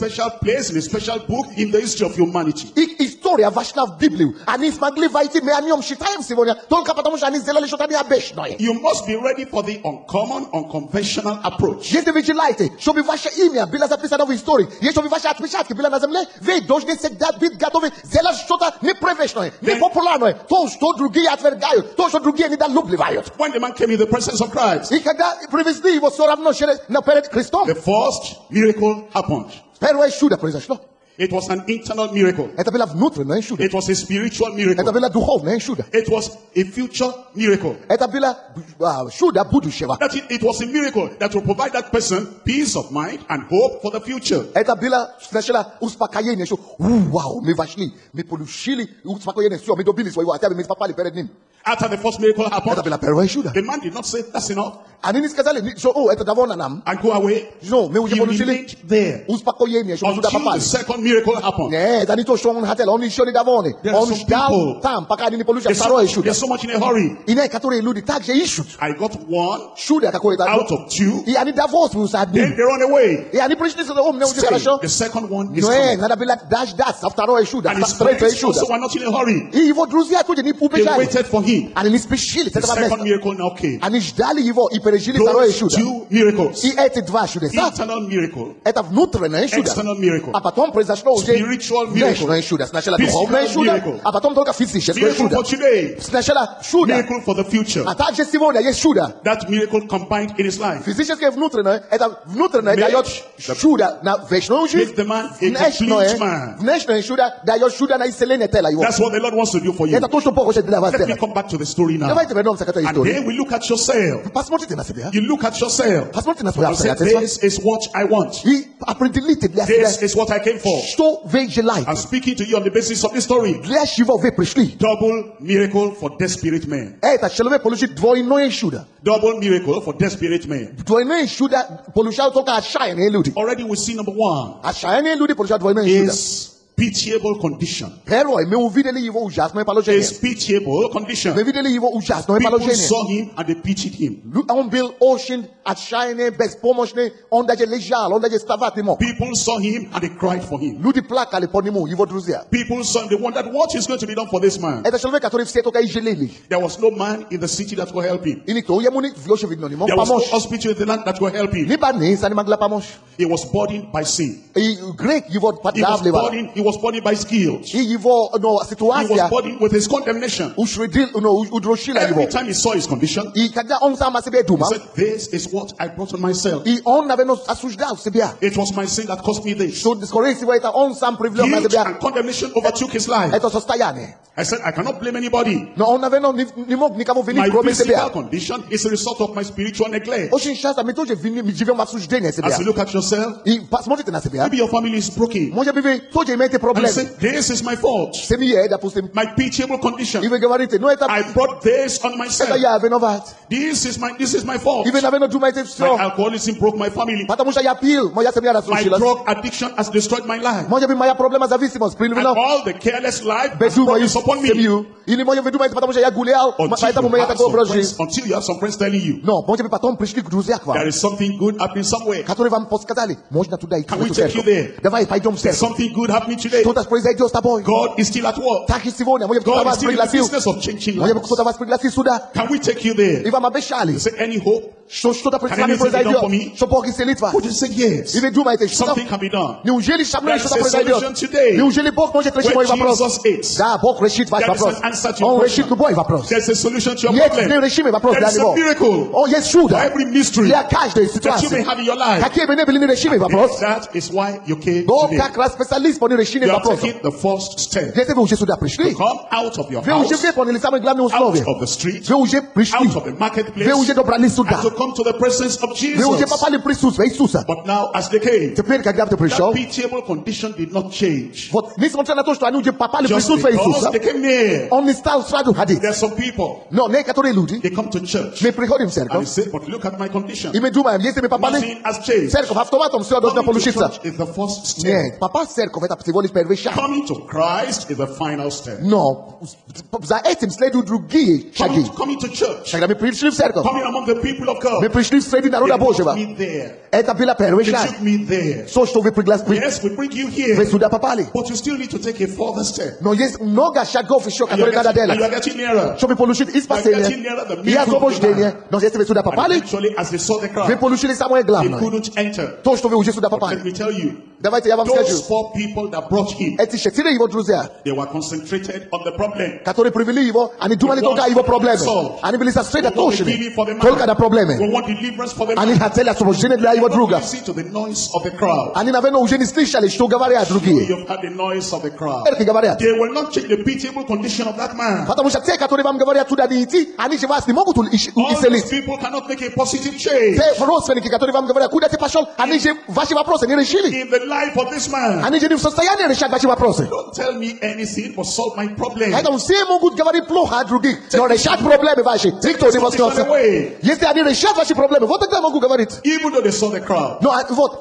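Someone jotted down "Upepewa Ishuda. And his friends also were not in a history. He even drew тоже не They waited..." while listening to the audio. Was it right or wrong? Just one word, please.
wrong.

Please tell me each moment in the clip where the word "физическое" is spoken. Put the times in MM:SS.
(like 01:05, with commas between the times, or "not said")
01:34, 01:40.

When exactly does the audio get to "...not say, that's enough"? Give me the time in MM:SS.
00:53.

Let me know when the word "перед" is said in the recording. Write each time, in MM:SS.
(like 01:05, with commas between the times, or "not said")
00:27, 00:50.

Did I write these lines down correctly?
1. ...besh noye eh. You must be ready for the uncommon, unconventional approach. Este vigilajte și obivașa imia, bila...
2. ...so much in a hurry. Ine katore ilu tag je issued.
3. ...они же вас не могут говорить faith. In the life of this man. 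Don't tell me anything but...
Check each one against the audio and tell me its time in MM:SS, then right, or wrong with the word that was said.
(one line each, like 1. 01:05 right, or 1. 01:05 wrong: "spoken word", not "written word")
1. 00:08 right
2. 01:06 right
3. 05:36 wrong: "исцелить", not "говорить".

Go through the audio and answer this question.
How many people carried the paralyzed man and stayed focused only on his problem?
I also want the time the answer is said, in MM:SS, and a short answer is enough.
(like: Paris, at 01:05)
4, at 05:15.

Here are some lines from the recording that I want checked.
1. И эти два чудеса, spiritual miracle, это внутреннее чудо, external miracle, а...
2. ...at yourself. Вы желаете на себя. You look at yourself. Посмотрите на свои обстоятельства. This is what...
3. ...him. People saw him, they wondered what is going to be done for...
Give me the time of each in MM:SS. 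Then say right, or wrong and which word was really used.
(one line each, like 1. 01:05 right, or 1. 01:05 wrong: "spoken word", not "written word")
1. 01:26 wrong: "internal", not "spiritual"
2. 01:53 wrong: "посмотрите", not "желаете"
3. 02:30 right.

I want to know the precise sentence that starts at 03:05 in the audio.
No, on avait, non, My physical condition is a result of my spiritual neglect.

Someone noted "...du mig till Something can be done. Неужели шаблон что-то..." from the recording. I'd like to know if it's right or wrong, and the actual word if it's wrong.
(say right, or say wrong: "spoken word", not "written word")
right.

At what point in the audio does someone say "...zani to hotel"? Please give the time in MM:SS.
01:02.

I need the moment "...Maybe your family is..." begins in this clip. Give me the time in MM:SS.
03:14.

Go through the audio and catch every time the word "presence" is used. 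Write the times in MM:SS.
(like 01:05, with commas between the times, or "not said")
00:24, 04:25.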